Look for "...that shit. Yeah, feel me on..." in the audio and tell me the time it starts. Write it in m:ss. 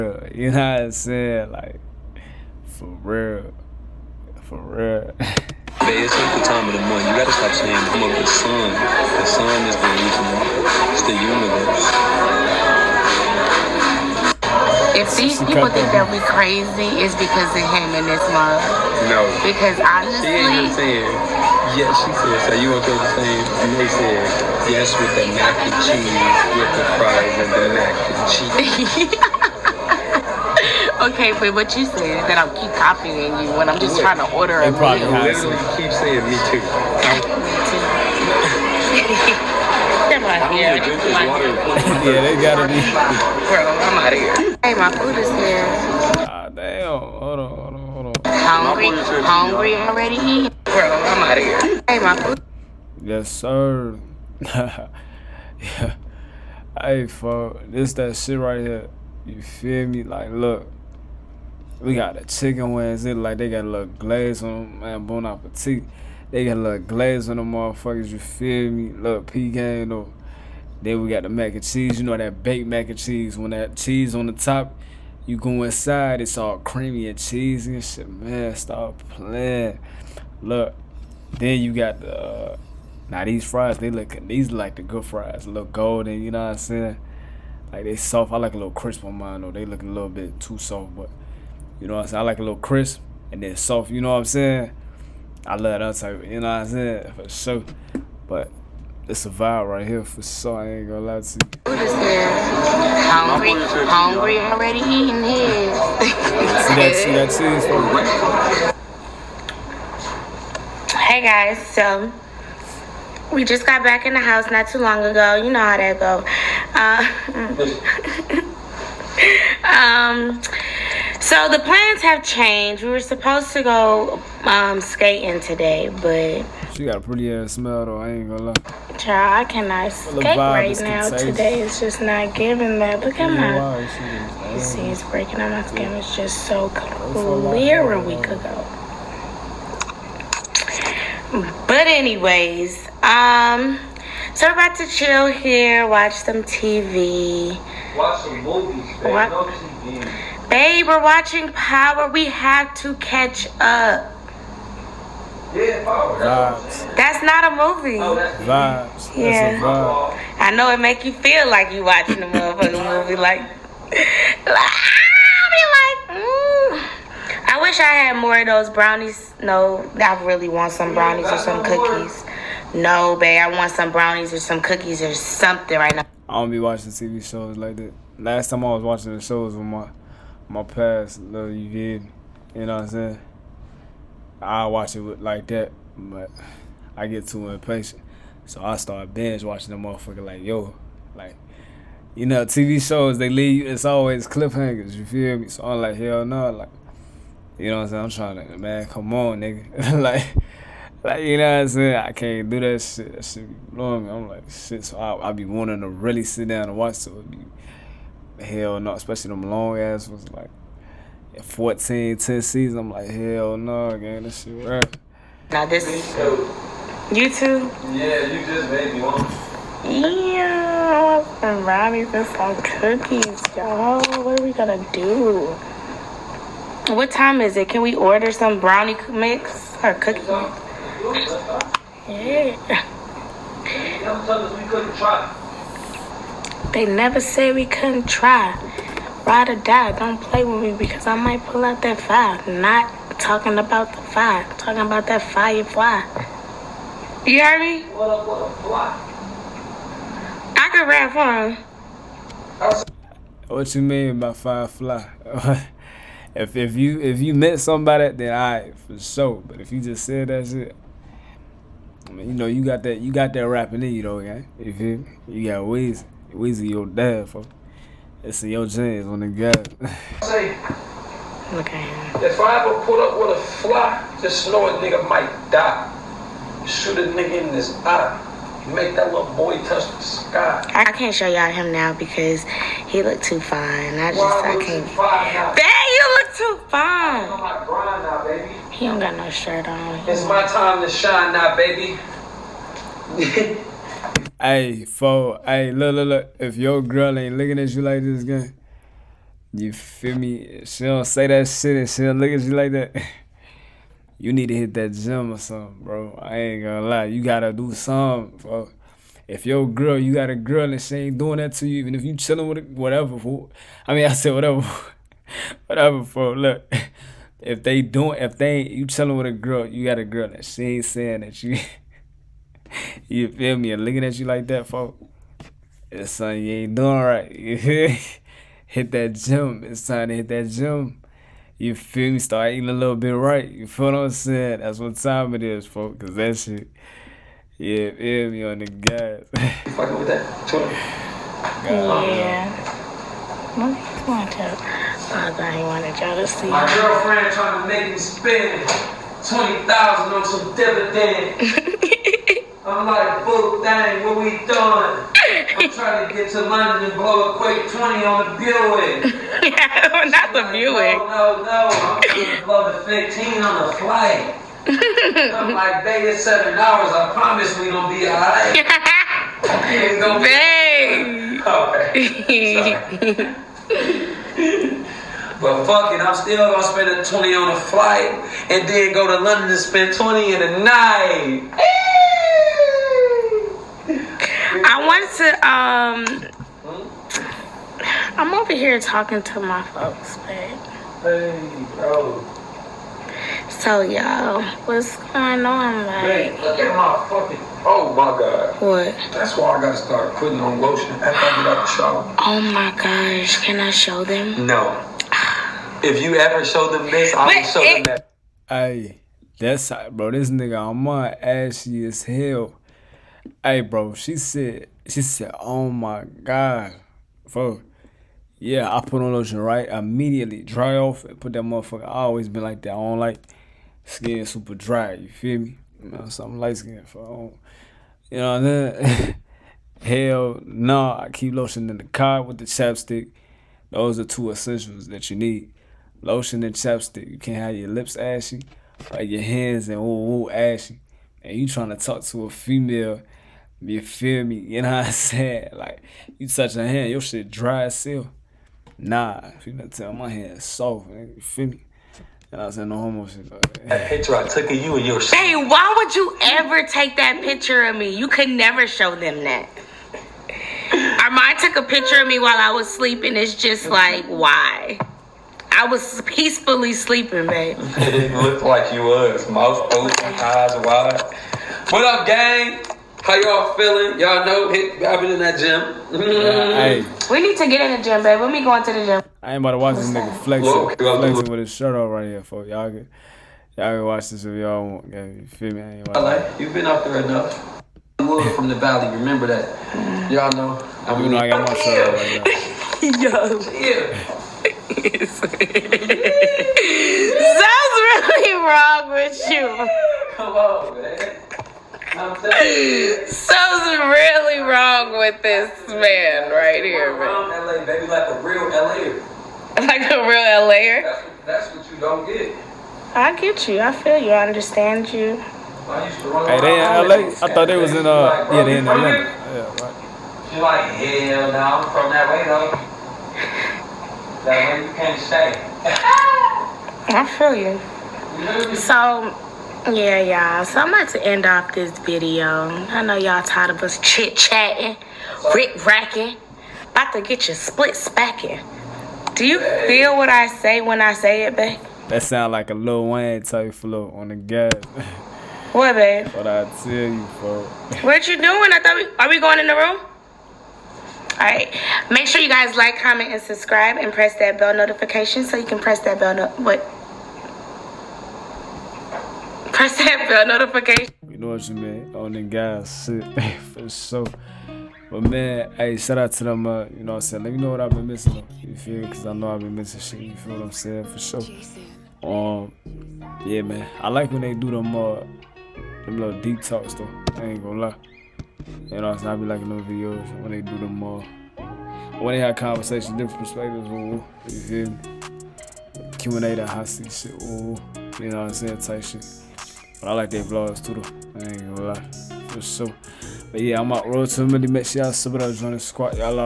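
5:36.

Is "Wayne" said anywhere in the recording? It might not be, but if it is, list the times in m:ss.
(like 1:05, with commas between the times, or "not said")
9:02.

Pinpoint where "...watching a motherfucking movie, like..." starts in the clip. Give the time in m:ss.
2:41.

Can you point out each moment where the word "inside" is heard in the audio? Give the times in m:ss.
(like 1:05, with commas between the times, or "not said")
1:15.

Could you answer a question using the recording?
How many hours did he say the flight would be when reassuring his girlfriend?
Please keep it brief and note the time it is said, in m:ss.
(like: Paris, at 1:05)
7, at 6:06.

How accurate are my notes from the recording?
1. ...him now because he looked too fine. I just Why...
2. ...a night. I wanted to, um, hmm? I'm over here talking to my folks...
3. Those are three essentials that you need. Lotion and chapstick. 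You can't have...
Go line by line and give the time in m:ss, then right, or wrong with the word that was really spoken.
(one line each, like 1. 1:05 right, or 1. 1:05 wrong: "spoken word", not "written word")
1. 4:41 right
2. 6:20 right
3. 7:13 wrong: "two", not "three".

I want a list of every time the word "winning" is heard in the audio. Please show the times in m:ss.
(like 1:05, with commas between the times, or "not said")
not said.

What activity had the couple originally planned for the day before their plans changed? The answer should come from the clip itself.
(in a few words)
Skating.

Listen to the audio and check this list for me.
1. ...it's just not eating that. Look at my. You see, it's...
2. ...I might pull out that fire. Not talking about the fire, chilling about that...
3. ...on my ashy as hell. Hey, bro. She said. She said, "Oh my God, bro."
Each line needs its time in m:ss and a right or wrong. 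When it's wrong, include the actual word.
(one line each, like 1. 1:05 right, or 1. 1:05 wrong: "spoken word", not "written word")
1. 2:11 wrong: "giving", not "eating"
2. 4:01 wrong: "talking", not "chilling"
3. 6:50 right.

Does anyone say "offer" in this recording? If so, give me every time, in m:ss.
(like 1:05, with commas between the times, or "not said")
not said.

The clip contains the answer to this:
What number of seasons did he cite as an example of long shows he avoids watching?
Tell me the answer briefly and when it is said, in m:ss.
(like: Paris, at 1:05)
10, at 3:32.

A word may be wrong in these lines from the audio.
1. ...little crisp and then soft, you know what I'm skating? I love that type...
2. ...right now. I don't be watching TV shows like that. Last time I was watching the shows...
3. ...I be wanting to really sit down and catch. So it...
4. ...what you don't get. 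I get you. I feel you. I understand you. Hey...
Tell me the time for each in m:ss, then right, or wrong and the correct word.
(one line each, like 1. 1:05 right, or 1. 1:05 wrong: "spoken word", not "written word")
1. 1:32 wrong: "saying", not "skating"
2. 2:55 right
3. 3:25 wrong: "watch", not "catch"
4. 8:31 right.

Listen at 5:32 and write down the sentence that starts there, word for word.
Start eating a little bit right.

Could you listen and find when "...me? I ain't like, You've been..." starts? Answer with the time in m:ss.
8:05.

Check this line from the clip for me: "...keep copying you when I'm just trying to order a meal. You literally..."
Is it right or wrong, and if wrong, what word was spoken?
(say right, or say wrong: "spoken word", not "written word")
right.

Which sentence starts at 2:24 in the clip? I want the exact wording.
So we're about to chill here, watch some TV.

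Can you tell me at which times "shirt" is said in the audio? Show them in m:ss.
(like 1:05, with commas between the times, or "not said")
4:49, 8:01, 8:11.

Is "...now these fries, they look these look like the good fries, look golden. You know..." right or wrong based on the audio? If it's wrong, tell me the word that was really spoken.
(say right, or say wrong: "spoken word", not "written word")
right.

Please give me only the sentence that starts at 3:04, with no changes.
I watch it like that, but I get too impatient.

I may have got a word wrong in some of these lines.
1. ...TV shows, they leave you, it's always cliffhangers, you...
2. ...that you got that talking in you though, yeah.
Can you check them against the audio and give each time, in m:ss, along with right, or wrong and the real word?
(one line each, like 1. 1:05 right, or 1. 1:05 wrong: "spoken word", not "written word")
1. 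3:12 right
2. 4:22 wrong: "rapping", not "talking".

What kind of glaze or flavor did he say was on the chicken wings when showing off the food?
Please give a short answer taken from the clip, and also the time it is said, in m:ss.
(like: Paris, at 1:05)
Pecan, at 1:08.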